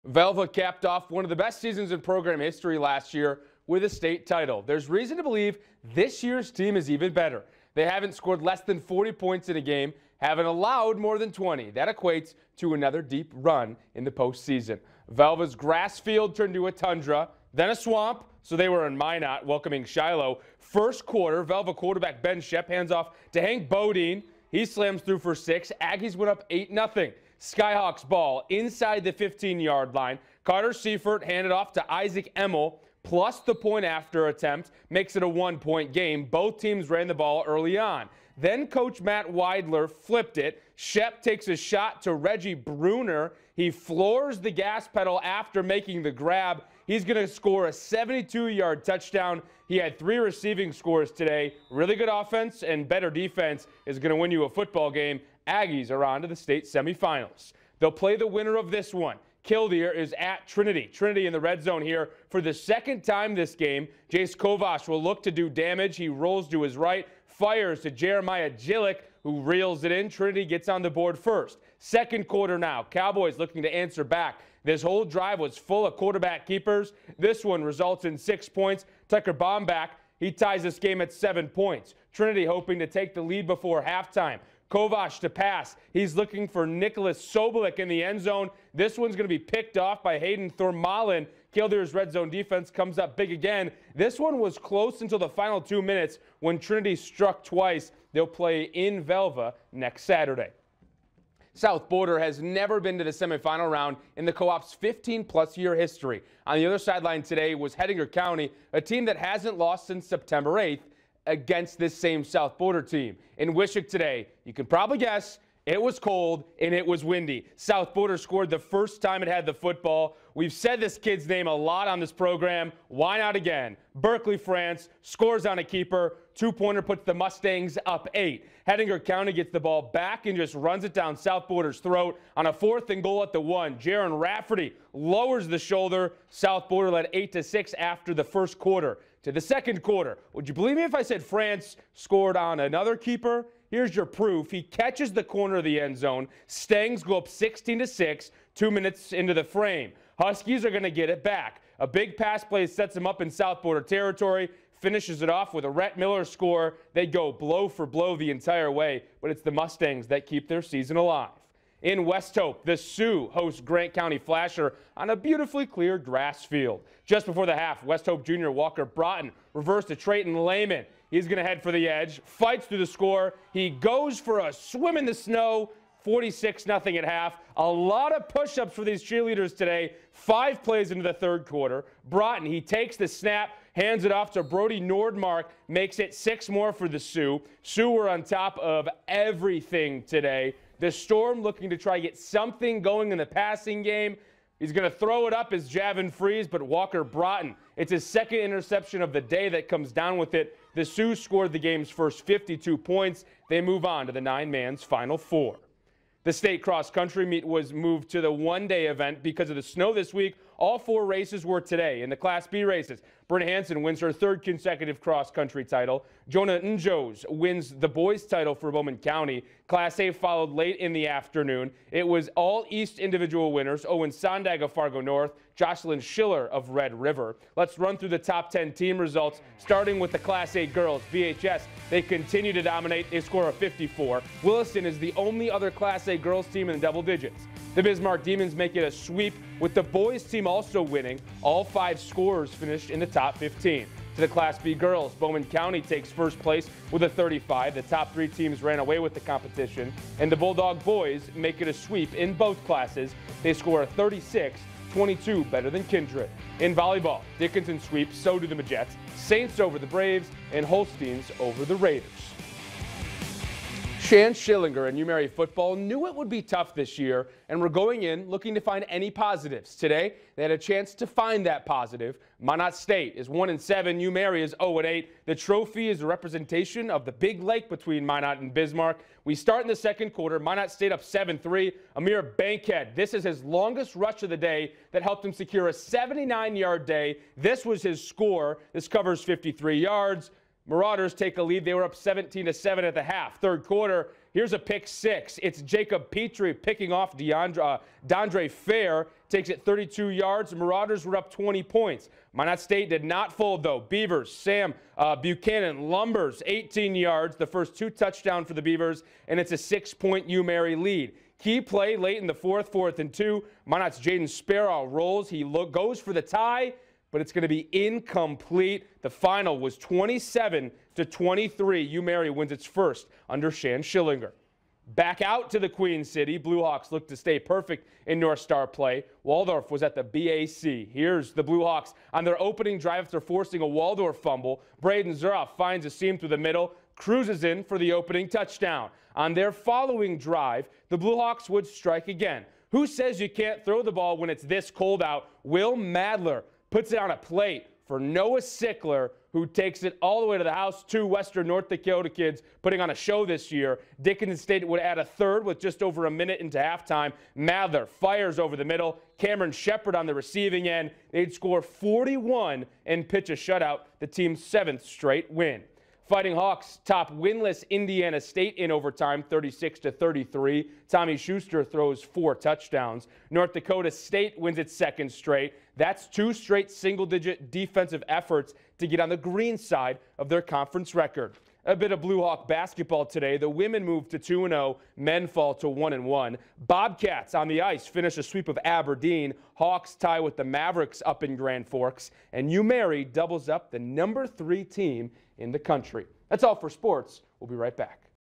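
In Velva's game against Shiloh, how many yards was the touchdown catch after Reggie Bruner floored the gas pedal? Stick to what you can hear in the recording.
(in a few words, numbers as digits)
72.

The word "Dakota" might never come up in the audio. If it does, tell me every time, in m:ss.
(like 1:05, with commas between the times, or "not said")
5:51, 6:13.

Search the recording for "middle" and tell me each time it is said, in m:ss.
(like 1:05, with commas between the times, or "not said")
5:36, 5:58.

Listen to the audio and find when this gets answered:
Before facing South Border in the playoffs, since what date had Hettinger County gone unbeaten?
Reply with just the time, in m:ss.
1:50.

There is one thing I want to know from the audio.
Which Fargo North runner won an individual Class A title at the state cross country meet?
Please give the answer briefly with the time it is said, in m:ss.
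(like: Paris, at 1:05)
Owen Sondag, at 3:43.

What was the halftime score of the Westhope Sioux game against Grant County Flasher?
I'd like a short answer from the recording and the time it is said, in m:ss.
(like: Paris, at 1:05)
46-0, at 2:55.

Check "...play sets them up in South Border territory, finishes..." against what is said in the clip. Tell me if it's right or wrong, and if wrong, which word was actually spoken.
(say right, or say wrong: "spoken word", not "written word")
right.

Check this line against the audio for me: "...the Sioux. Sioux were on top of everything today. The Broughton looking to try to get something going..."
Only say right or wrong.
wrong.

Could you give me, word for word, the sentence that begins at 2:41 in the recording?
In Westhope, the Sioux host Grant County Flasher on a beautifully clear grass field.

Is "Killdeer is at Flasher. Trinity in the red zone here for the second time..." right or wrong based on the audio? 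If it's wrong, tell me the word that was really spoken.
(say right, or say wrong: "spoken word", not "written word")
wrong: "Trinity", not "Flasher".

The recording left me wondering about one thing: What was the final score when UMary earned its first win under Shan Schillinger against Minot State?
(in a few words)
27-23.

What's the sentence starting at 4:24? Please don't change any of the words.
Shan Schillinger and UMary football knew it would be tough this year and were going in looking to find any positives.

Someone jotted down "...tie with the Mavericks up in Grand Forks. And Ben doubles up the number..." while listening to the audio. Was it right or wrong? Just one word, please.
wrong.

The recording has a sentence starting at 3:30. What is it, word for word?
All four races were today in the Class B races.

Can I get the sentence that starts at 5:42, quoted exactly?
Who says you can't throw the ball when it's this cold out?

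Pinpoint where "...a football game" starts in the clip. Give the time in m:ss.
0:54.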